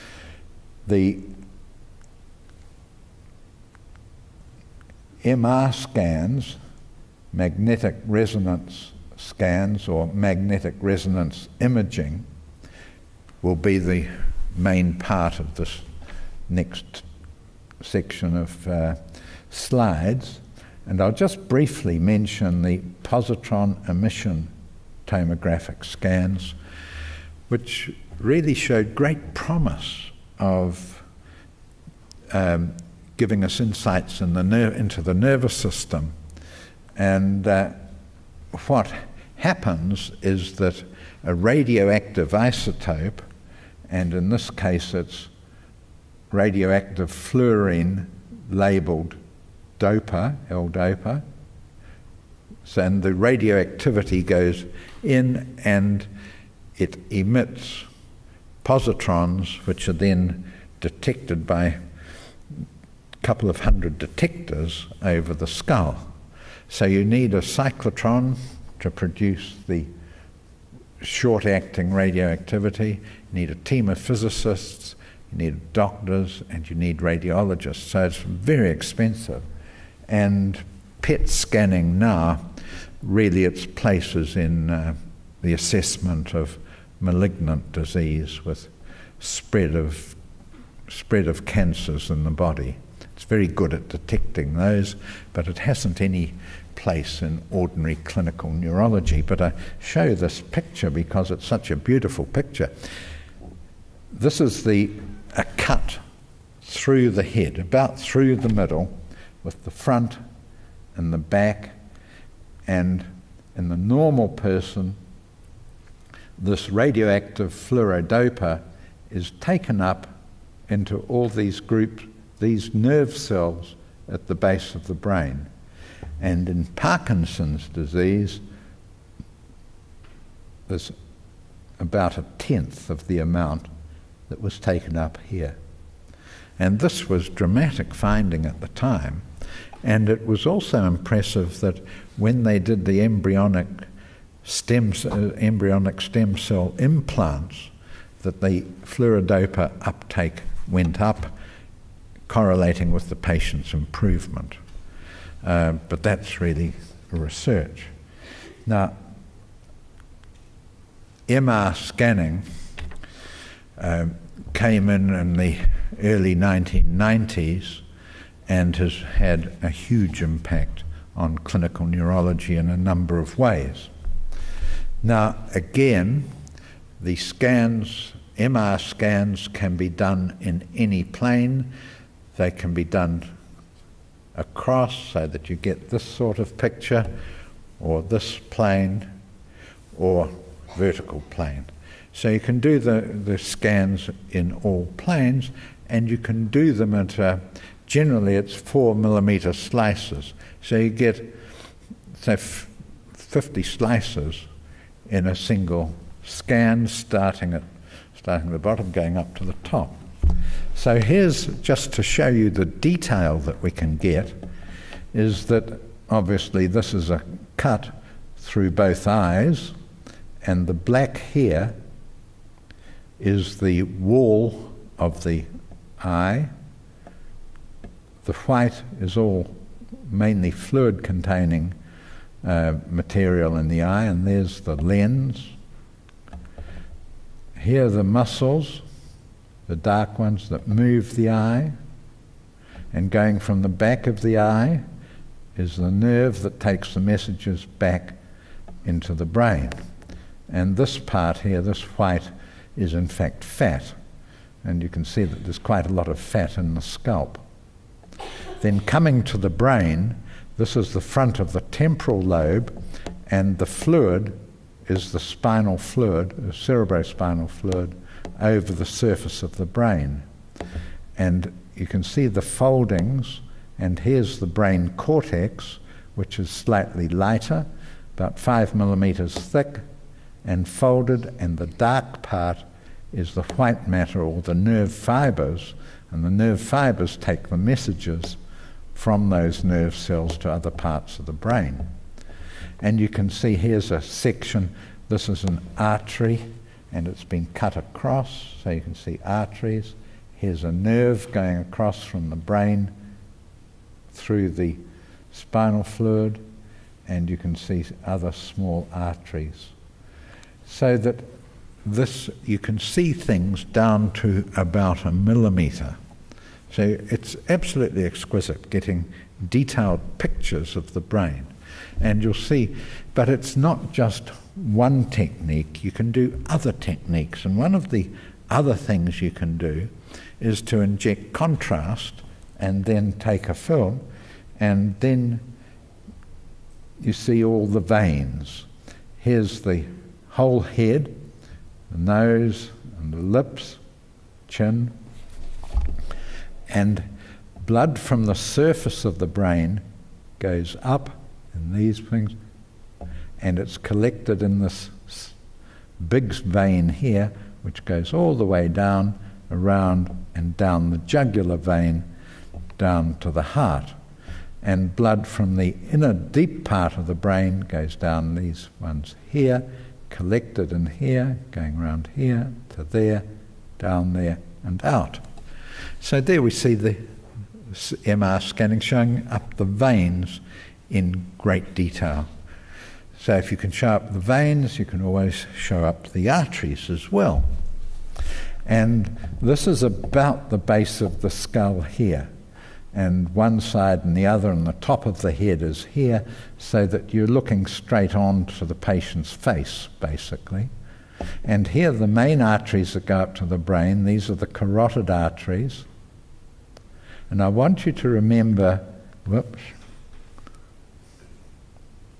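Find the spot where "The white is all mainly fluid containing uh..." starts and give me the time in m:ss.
3:48.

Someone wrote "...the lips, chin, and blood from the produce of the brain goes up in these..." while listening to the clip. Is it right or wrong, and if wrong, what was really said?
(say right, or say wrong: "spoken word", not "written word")
wrong: "surface", not "produce".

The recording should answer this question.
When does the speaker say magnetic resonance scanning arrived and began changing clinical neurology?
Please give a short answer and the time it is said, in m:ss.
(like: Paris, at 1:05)
early 1990s, at 2:46.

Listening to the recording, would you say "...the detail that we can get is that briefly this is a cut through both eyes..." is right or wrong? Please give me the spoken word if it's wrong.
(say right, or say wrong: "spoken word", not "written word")
wrong: "obviously", not "briefly".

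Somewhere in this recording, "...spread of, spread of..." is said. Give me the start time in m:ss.
1:29.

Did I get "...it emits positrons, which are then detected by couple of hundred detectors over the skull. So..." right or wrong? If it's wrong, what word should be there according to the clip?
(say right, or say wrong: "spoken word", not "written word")
right.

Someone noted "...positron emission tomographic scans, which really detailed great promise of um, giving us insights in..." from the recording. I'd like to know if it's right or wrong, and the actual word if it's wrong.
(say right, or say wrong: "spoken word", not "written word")
wrong: "showed", not "detailed".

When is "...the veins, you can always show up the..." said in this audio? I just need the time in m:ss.
6:24.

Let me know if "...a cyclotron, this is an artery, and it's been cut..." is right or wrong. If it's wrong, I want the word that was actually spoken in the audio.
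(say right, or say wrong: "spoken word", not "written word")
wrong: "section", not "cyclotron".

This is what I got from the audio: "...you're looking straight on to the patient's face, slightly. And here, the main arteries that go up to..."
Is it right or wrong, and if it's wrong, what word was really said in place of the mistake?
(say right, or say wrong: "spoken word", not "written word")
wrong: "basically", not "slightly".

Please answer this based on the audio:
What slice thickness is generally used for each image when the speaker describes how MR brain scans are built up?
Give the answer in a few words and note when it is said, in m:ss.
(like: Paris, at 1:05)
4 millimeters, at 3:18.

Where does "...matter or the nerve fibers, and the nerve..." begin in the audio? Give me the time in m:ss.
4:43.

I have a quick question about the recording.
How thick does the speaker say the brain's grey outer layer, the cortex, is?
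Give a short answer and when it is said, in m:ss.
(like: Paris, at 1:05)
about 5 millimeters, at 4:38.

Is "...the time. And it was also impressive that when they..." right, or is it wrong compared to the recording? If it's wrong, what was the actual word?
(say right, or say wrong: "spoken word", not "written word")
right.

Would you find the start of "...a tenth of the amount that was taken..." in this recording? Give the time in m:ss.
2:12.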